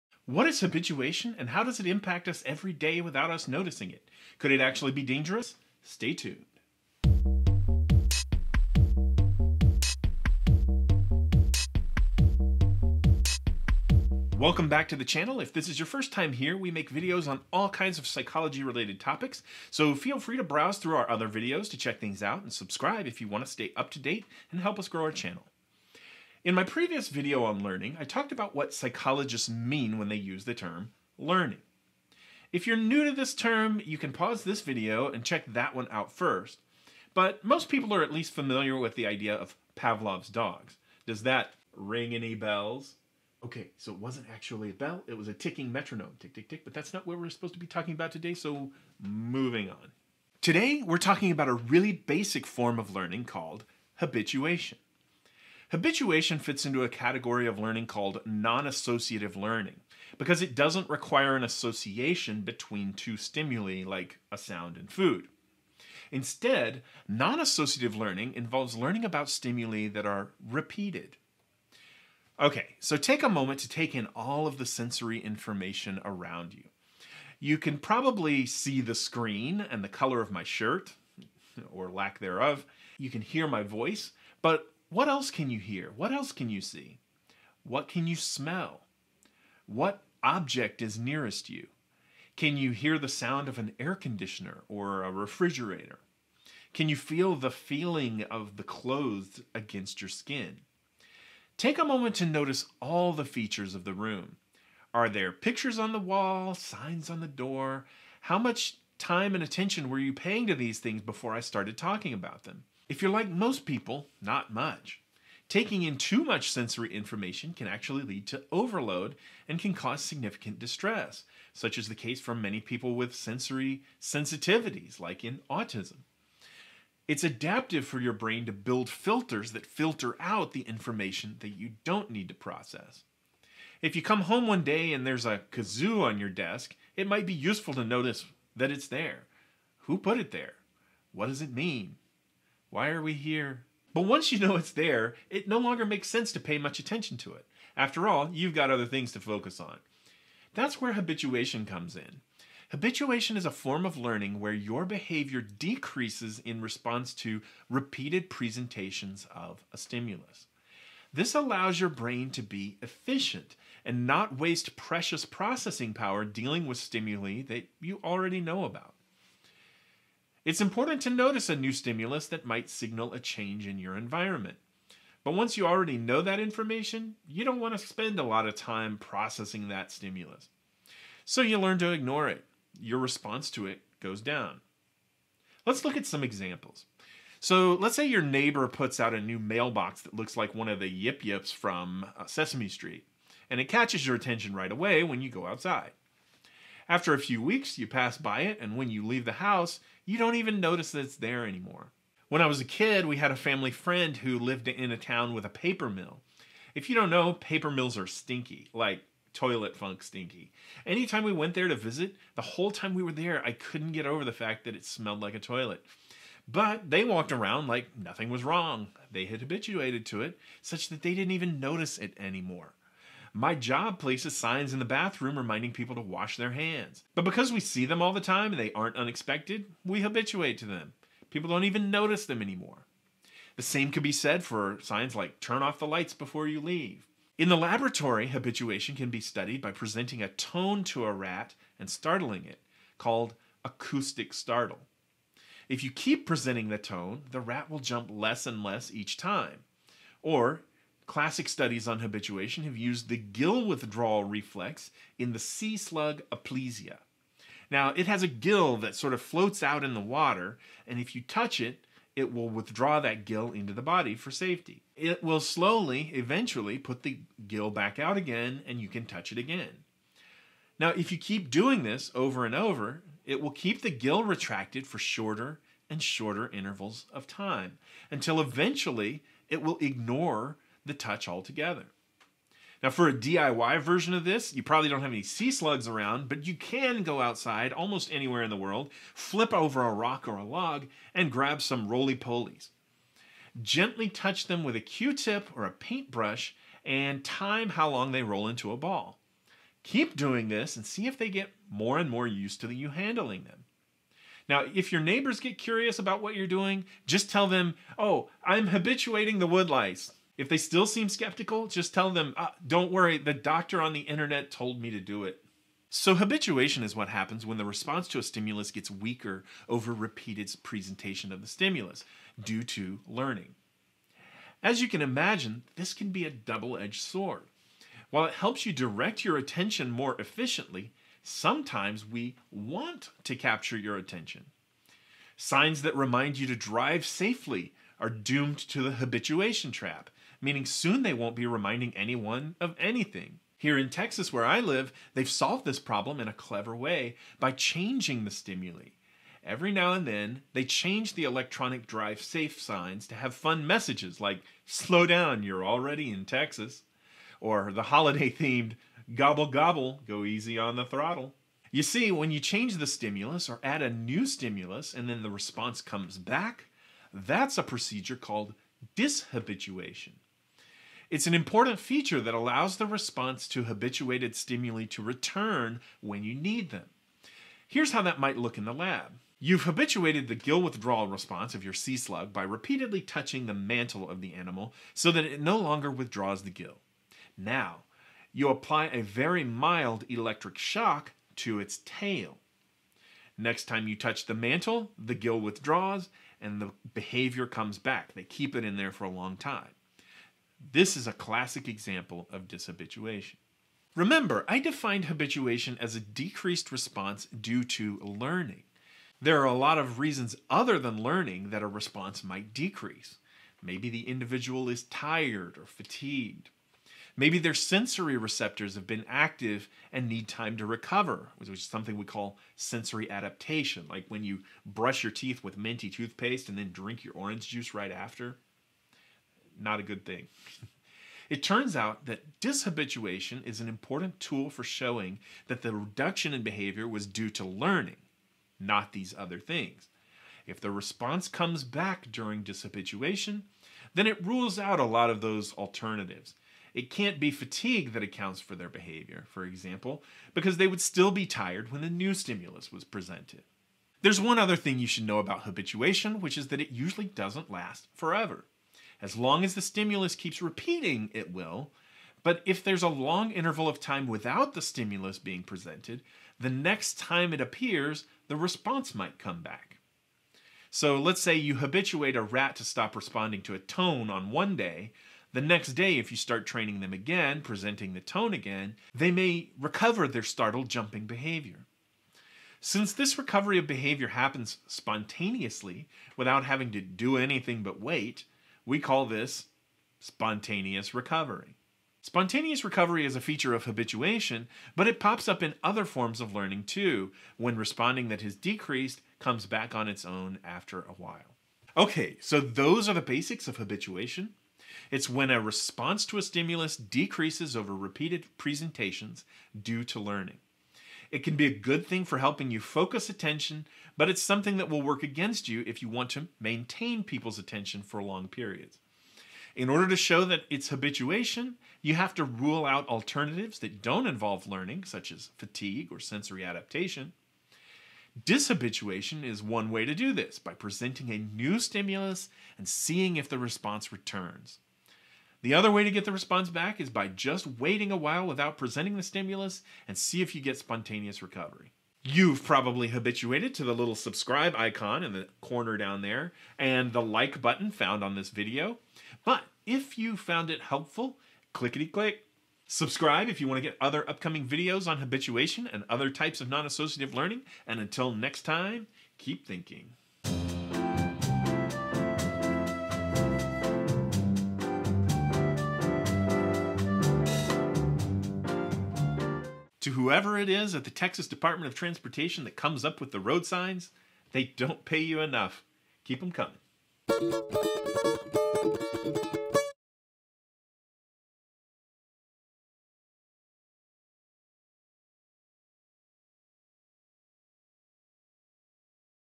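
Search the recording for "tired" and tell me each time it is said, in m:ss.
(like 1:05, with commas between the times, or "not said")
6:54, 7:31.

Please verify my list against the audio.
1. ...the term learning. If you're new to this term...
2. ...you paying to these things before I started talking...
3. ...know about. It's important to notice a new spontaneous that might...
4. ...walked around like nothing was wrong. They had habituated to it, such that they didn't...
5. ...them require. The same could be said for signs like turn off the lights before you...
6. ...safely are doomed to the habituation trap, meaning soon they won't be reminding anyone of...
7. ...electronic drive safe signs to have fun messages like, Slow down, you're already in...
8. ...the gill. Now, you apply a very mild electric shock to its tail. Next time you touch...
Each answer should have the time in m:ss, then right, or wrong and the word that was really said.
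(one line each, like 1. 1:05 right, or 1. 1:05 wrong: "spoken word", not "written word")
1. 0:30 right
2. 1:49 right
3. 2:48 wrong: "stimulus", not "spontaneous"
4. 3:37 right
5. 3:52 wrong: "anymore", not "require"
6. 5:37 right
7. 5:51 right
8. 6:26 right.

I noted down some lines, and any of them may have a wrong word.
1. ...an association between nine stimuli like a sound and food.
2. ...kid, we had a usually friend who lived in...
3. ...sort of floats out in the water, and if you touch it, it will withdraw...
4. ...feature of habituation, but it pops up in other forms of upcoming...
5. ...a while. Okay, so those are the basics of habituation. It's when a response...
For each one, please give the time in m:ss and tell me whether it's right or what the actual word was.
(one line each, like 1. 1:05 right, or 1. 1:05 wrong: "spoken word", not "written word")
1. 1:01 wrong: "two", not "nine"
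2. 3:22 wrong: "family", not "usually"
3. 4:18 right
4. 8:13 wrong: "learning", not "upcoming"
5. 8:20 right.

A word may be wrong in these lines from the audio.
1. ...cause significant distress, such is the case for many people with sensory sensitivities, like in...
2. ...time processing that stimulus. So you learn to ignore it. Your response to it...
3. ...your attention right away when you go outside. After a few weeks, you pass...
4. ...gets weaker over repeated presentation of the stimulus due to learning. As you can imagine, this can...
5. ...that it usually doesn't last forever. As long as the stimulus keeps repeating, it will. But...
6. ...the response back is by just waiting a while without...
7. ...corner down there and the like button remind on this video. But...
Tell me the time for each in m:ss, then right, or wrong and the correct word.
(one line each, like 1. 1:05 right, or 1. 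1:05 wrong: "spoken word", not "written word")
1. 1:59 right
2. 2:58 right
3. 3:14 right
4. 5:18 right
5. 7:36 right
6. 8:56 right
7. 9:05 wrong: "found", not "remind".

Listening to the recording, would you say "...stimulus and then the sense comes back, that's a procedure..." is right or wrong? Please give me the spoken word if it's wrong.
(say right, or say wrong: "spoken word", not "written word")
wrong: "response", not "sense".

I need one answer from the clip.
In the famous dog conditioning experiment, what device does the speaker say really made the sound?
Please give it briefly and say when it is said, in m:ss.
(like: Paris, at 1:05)
A ticking metronome, at 0:45.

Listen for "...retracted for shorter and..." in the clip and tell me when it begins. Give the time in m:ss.
4:34.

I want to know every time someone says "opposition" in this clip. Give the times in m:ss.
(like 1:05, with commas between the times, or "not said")
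not said.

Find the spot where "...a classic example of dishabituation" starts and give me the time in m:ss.
6:41.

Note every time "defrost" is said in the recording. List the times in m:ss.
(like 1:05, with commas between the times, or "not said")
not said.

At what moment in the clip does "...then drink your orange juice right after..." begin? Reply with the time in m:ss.
7:06.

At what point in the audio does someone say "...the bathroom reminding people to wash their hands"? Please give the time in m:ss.
3:44.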